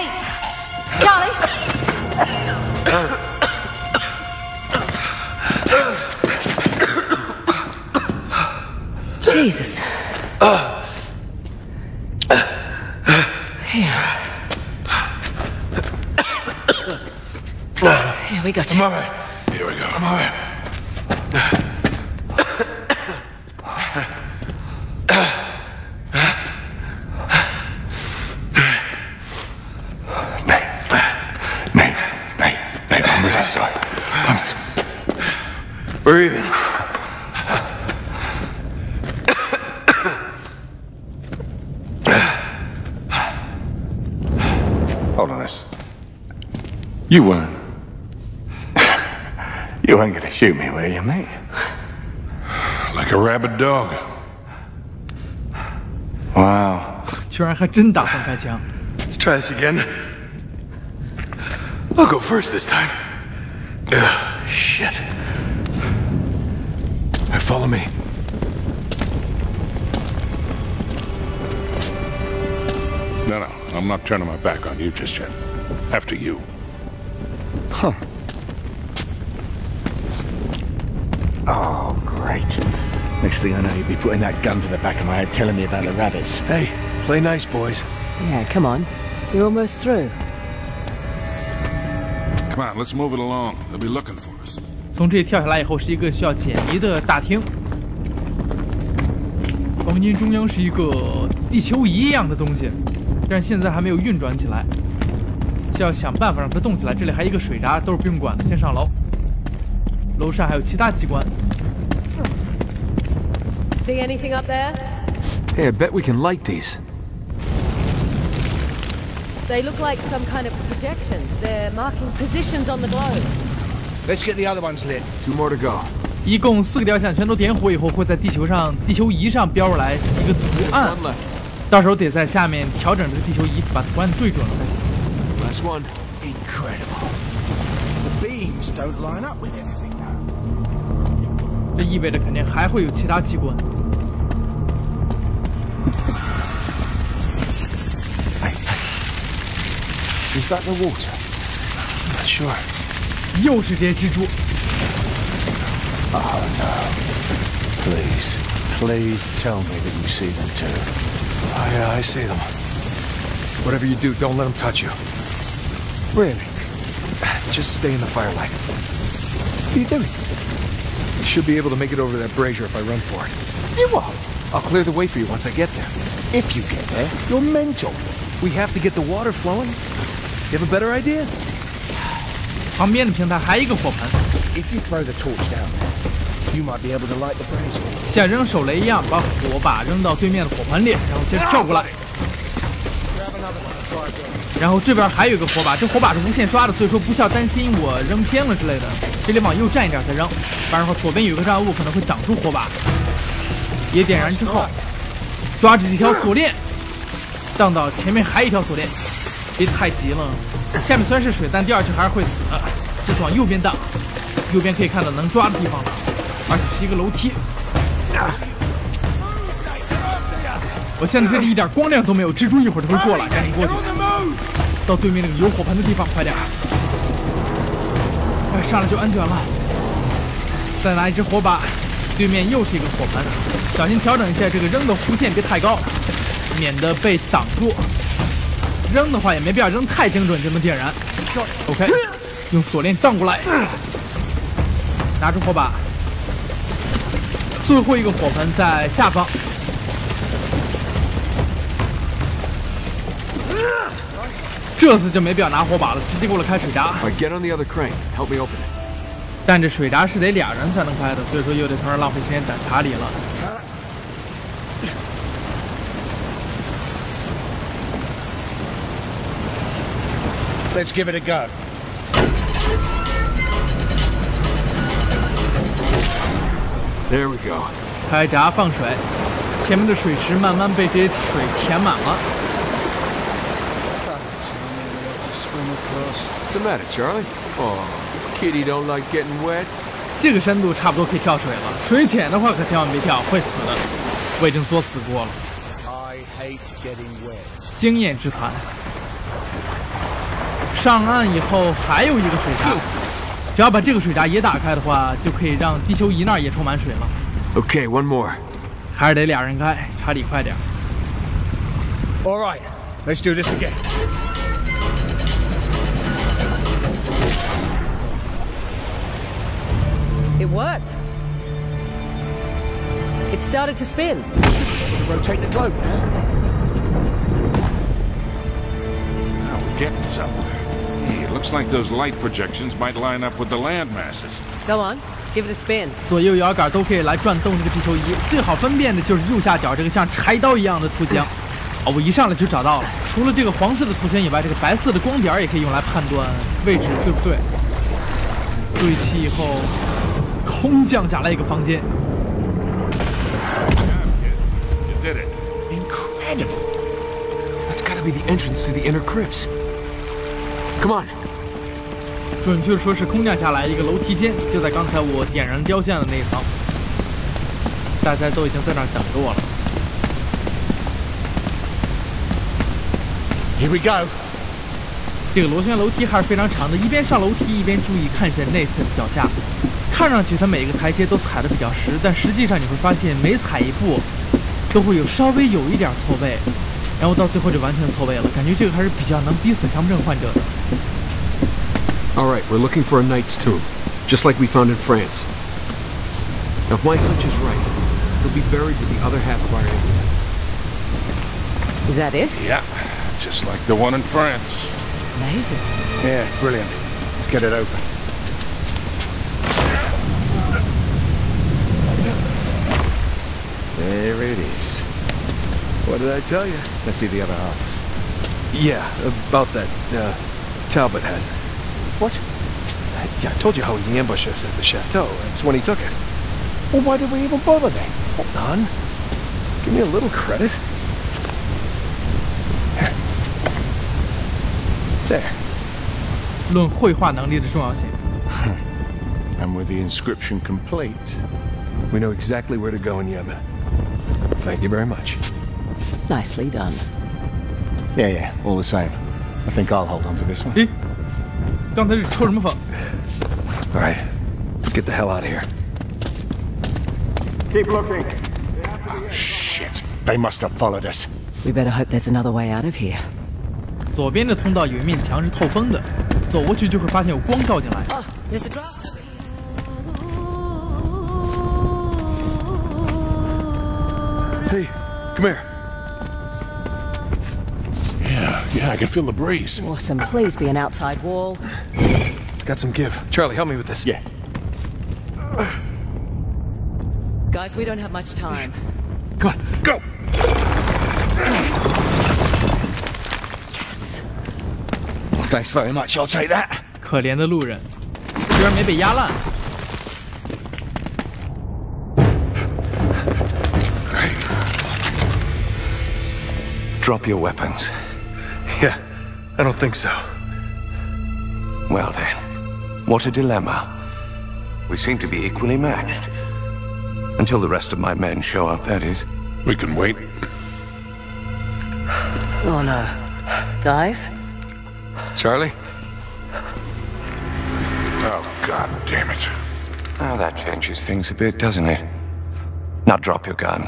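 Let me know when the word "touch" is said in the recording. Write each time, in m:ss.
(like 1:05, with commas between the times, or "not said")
2:44.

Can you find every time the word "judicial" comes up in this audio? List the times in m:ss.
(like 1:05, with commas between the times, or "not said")
not said.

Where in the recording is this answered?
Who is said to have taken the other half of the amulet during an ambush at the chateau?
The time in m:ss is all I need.
7:00.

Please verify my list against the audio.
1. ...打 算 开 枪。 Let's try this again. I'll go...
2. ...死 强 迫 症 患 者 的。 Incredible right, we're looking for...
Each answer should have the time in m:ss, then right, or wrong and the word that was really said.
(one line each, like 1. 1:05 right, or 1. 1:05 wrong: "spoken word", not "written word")
1. 0:57 right
2. 6:29 wrong: "All", not "Incredible".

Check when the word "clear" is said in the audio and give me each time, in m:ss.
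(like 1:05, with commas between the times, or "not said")
2:54.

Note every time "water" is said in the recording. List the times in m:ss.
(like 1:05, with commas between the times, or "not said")
2:30, 2:59.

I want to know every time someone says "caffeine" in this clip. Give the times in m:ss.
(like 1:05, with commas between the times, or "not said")
not said.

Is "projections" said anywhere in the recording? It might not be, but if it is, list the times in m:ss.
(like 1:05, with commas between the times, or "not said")
2:00, 5:32.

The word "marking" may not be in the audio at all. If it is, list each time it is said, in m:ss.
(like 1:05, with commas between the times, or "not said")
2:01.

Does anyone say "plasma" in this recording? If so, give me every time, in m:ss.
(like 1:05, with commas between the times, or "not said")
not said.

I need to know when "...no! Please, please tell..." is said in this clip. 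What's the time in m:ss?
2:36.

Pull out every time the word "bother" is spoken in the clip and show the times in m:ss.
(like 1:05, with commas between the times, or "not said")
7:07.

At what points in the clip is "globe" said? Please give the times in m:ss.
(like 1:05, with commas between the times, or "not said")
2:02, 5:25.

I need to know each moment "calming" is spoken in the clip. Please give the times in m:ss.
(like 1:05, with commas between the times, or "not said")
not said.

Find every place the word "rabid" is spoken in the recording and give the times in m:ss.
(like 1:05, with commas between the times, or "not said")
0:53.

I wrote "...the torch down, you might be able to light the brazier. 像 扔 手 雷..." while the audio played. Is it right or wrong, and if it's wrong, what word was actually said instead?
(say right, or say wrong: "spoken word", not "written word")
right.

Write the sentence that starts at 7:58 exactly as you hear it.
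Yeah, yeah, I can feel the breeze.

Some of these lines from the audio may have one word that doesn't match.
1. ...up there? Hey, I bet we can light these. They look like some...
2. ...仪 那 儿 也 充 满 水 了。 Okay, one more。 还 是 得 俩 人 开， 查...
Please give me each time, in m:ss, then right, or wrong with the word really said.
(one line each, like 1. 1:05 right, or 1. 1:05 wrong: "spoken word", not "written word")
1. 1:54 right
2. 5:06 right.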